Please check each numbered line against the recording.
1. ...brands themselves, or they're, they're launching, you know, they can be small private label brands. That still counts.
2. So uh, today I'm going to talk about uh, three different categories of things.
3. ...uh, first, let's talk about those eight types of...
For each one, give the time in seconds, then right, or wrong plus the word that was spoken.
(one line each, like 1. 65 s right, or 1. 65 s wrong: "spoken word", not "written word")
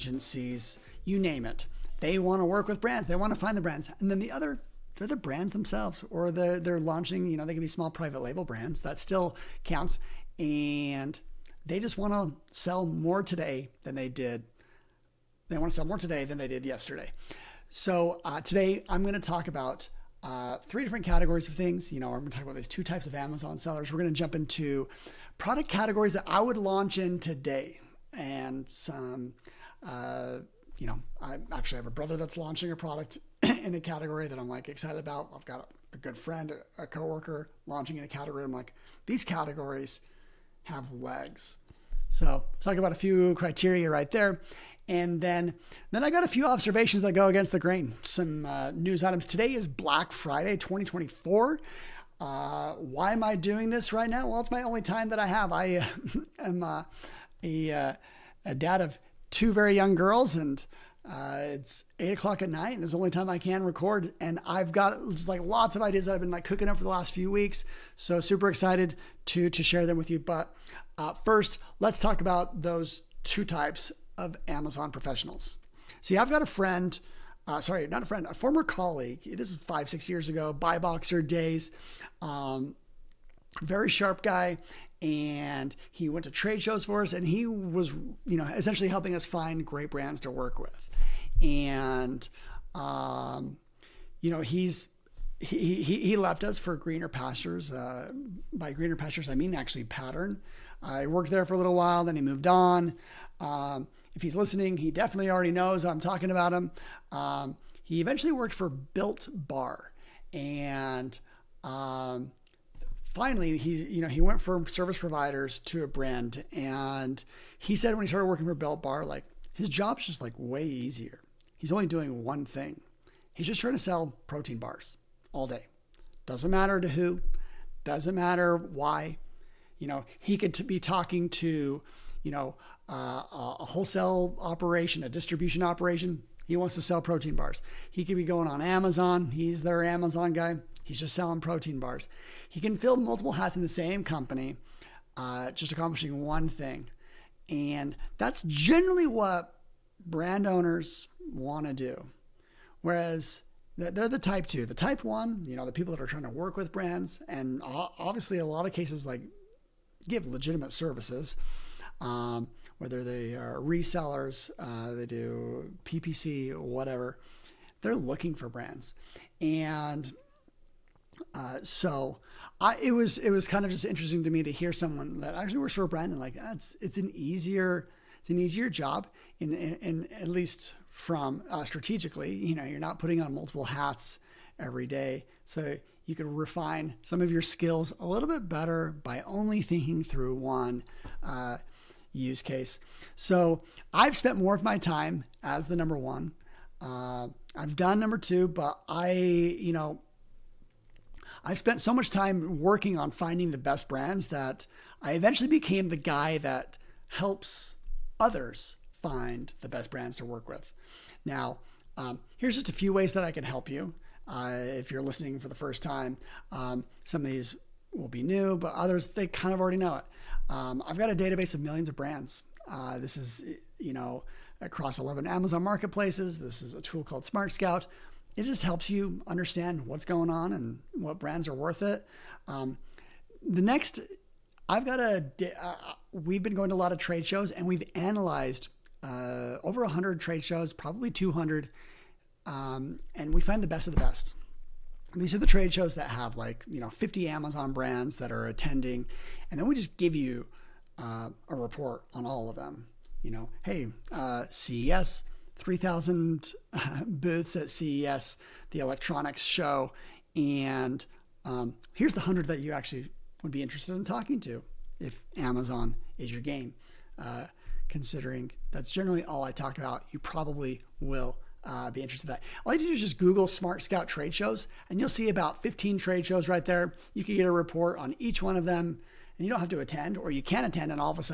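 1. 5 s right
2. 17 s right
3. 70 s wrong: "two", not "eight".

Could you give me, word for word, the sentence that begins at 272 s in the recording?
All you do is just Google Smart Scout trade shows, and you'll see about 15 trade shows right there.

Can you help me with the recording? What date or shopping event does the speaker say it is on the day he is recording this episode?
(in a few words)
Black Friday 2024.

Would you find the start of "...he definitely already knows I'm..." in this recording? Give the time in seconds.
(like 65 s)
104 s.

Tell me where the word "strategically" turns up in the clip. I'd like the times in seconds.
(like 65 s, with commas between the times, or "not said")
181 s.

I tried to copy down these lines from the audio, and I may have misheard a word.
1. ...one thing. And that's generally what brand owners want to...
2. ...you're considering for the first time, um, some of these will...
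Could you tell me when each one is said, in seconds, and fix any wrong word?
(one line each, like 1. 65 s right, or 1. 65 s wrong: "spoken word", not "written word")
1. 146 s right
2. 214 s wrong: "listening", not "considering".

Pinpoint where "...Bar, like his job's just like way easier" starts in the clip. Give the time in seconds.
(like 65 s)
118 s.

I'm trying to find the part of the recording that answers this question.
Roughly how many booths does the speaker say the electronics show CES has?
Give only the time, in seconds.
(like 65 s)
255 s.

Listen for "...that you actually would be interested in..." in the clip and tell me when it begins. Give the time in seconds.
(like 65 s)
262 s.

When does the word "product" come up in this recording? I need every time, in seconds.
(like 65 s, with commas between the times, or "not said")
25 s, 32 s.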